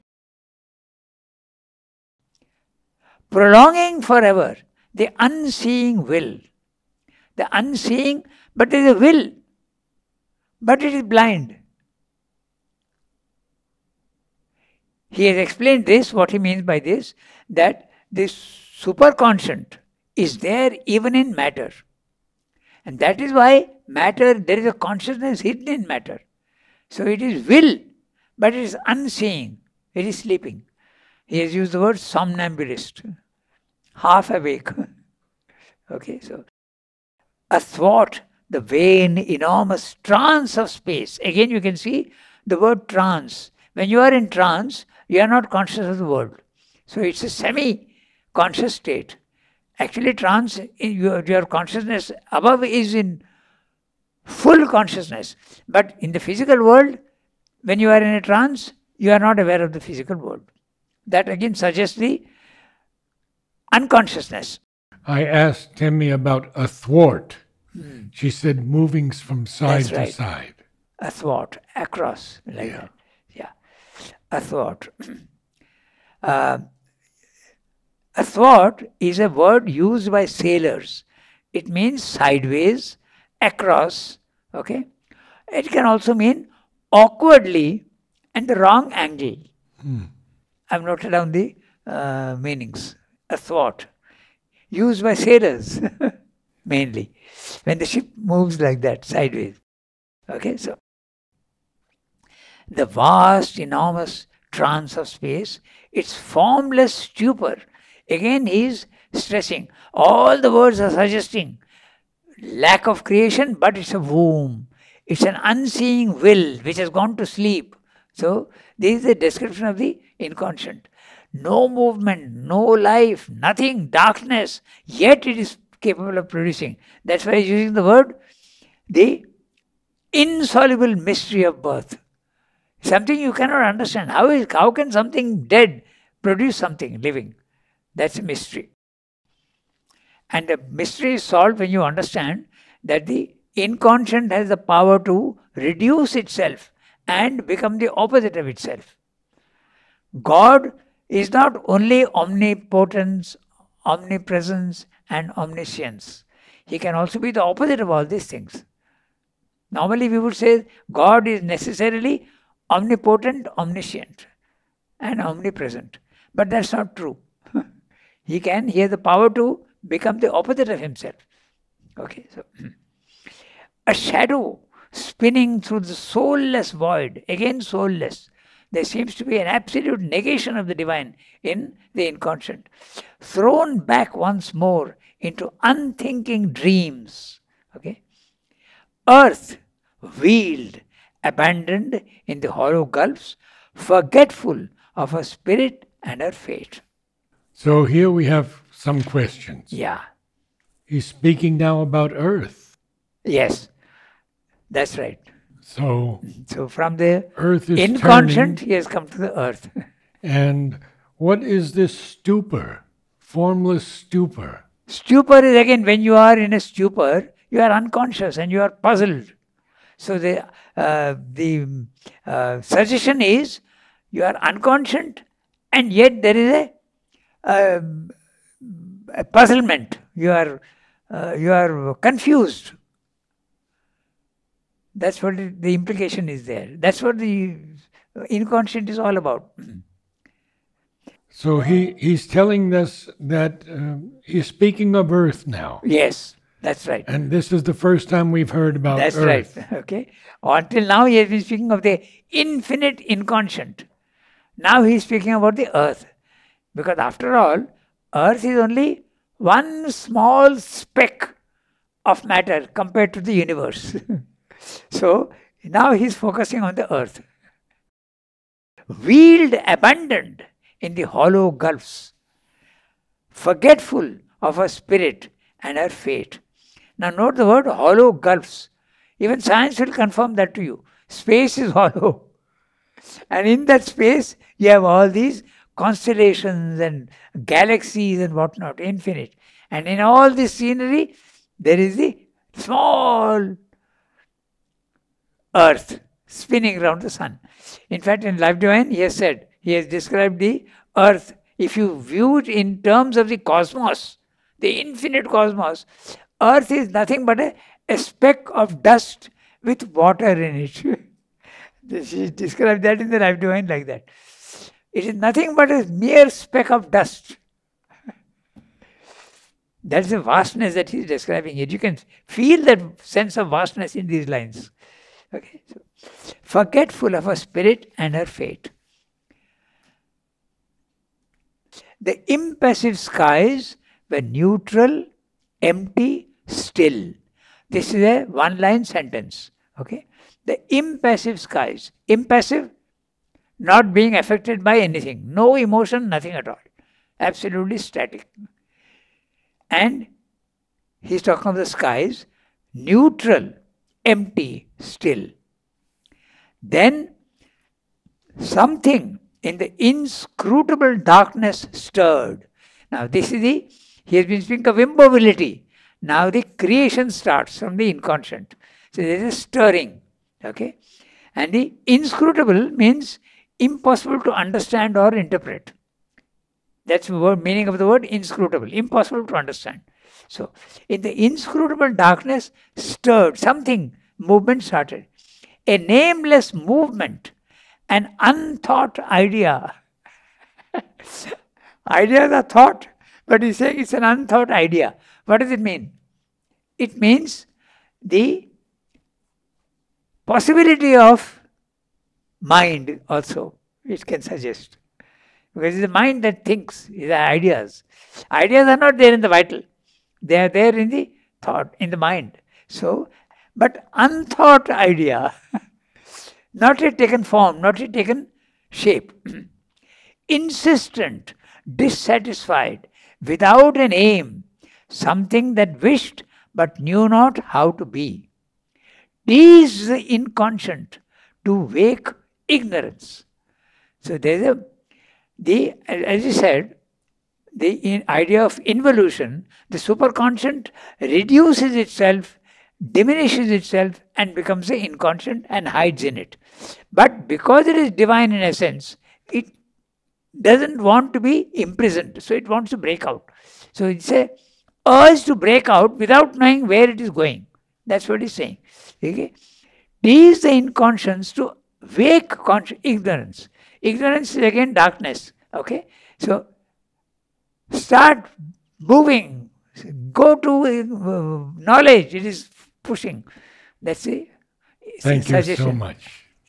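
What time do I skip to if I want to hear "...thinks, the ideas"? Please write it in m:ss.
6:46.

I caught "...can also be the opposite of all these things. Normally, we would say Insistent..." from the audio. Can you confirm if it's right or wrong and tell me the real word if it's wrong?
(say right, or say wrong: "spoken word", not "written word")
wrong: "God", not "Insistent".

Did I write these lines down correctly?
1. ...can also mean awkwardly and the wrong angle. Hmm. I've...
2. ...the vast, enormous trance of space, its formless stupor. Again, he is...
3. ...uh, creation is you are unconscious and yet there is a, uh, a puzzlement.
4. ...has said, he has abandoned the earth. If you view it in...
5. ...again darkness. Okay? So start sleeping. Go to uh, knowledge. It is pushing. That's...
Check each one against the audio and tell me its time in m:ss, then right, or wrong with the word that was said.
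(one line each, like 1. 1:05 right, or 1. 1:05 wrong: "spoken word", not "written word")
1. 1:25 right
2. 1:42 right
3. 3:42 wrong: "suggestion", not "creation"
4. 4:59 wrong: "described", not "abandoned"
5. 7:44 wrong: "moving", not "sleeping".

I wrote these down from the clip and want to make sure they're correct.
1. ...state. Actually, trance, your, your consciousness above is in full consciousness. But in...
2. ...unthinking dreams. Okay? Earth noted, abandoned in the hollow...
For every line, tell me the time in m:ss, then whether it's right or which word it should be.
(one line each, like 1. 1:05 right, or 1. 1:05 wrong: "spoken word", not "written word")
1. 0:48 right
2. 3:05 wrong: "wheeled", not "noted".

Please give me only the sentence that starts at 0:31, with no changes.
He has used the word somnambulist, half awake.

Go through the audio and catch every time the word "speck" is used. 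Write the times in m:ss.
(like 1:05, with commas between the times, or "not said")
4:20, 5:07, 5:16.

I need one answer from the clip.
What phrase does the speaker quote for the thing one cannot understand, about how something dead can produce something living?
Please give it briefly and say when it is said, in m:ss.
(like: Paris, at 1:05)
the insoluble mystery of birth, at 2:08.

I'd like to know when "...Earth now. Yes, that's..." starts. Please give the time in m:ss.
4:05.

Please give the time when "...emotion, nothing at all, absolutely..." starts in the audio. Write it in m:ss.
5:45.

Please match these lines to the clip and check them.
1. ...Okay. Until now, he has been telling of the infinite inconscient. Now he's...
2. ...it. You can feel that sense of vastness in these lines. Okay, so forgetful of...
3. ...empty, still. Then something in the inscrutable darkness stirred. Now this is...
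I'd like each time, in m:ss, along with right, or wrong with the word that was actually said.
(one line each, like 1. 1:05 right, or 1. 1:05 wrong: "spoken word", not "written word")
1. 4:09 wrong: "speaking", not "telling"
2. 5:21 right
3. 5:54 right.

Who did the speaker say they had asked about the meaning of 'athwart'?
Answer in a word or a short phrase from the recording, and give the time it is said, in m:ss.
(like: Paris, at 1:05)
Timmy, at 1:05.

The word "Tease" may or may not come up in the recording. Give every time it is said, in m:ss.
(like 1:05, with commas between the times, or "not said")
7:09, 7:40.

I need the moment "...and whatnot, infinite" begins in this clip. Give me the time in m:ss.
4:48.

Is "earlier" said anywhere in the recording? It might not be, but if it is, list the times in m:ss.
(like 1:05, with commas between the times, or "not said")
not said.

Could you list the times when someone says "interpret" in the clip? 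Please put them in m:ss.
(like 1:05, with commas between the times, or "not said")
6:15.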